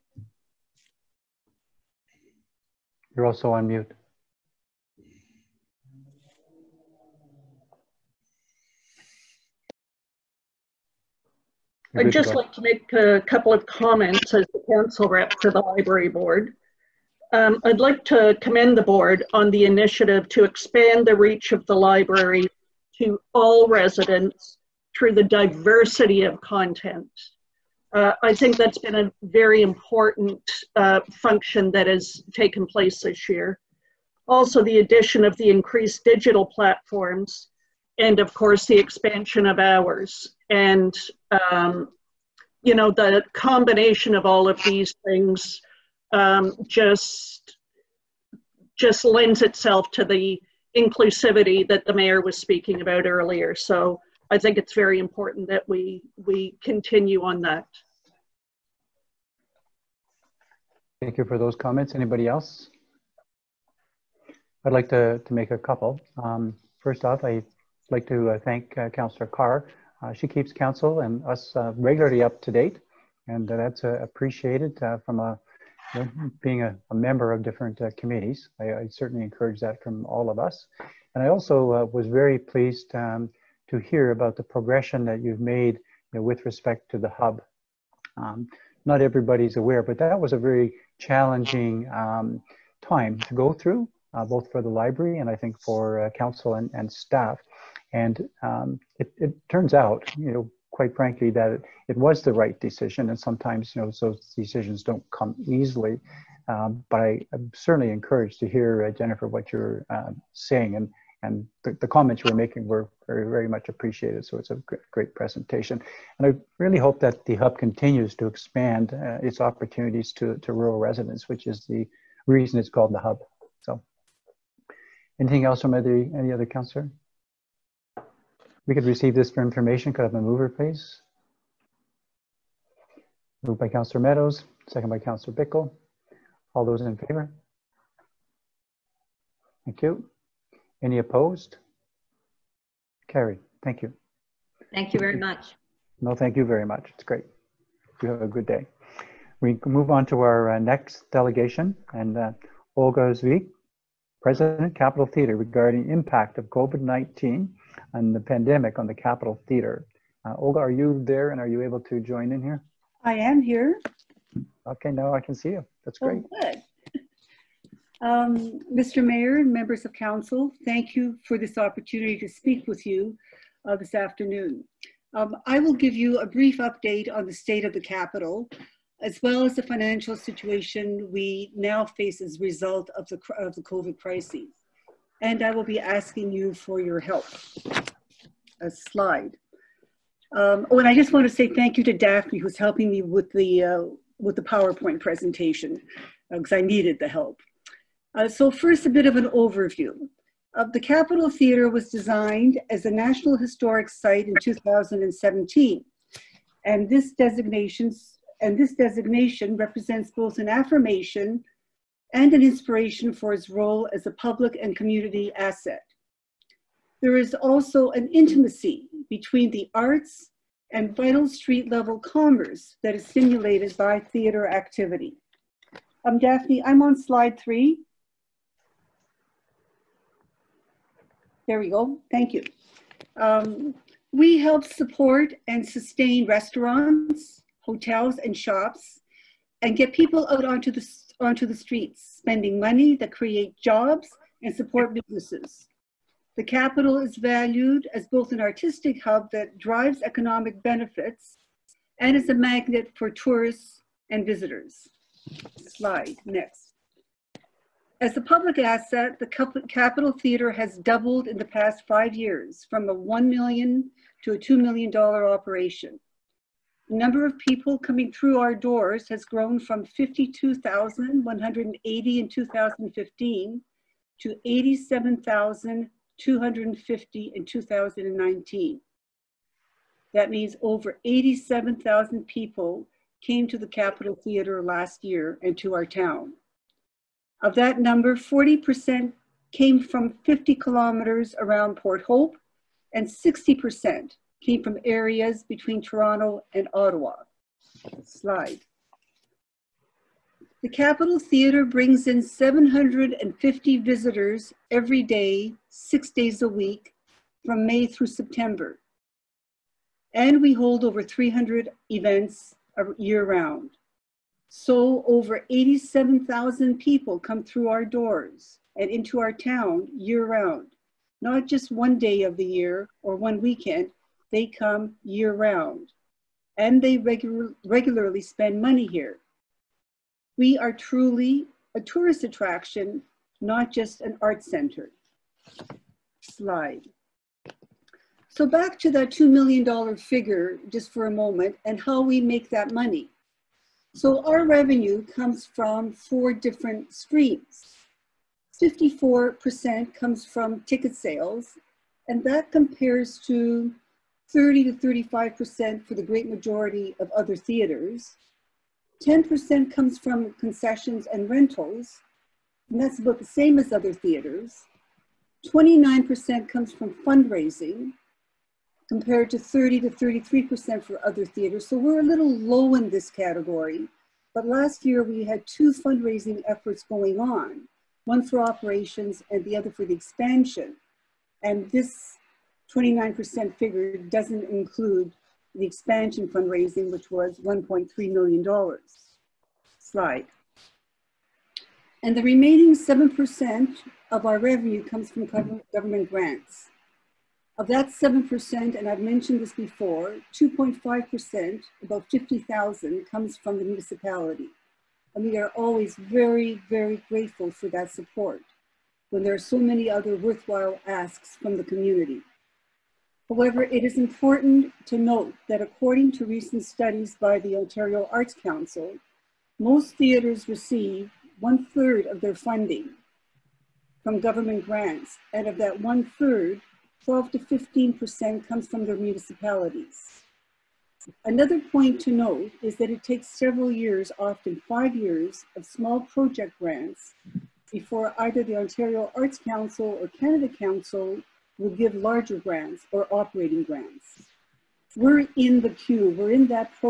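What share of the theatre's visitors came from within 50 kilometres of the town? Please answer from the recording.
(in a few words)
40%.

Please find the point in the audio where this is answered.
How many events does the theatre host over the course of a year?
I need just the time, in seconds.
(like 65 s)
310 s.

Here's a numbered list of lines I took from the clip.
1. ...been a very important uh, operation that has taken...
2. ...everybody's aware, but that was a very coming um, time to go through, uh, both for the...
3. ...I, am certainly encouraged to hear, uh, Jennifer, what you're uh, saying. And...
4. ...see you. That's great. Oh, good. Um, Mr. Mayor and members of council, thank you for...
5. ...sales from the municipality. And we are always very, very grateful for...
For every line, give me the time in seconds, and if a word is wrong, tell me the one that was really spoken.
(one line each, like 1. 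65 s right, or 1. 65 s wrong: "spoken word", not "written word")
1. 28 s wrong: "function", not "operation"
2. 89 s wrong: "challenging", not "coming"
3. 107 s right
4. 165 s right
5. 403 s wrong: "comes", not "sales".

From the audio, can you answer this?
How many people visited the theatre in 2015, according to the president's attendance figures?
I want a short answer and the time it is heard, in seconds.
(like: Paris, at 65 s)
52,180, at 269 s.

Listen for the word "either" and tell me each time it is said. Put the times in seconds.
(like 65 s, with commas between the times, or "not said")
438 s.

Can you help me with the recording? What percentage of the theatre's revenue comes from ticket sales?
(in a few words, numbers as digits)
54%.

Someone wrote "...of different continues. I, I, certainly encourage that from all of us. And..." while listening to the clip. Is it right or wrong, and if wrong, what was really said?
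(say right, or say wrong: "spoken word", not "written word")
wrong: "committees", not "continues".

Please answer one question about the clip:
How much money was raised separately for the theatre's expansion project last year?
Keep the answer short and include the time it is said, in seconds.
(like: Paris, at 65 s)
$1.3 million, at 387 s.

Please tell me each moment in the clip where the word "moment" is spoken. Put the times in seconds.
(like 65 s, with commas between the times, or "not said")
341 s.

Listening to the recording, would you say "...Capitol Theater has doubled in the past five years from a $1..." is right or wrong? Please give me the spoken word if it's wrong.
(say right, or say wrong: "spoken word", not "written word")
right.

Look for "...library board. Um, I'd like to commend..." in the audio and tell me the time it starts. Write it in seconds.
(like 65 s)
15 s.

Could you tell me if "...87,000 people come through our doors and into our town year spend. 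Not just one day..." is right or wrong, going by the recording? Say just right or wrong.
wrong.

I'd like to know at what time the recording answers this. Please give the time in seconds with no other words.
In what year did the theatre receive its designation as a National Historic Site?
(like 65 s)
204 s.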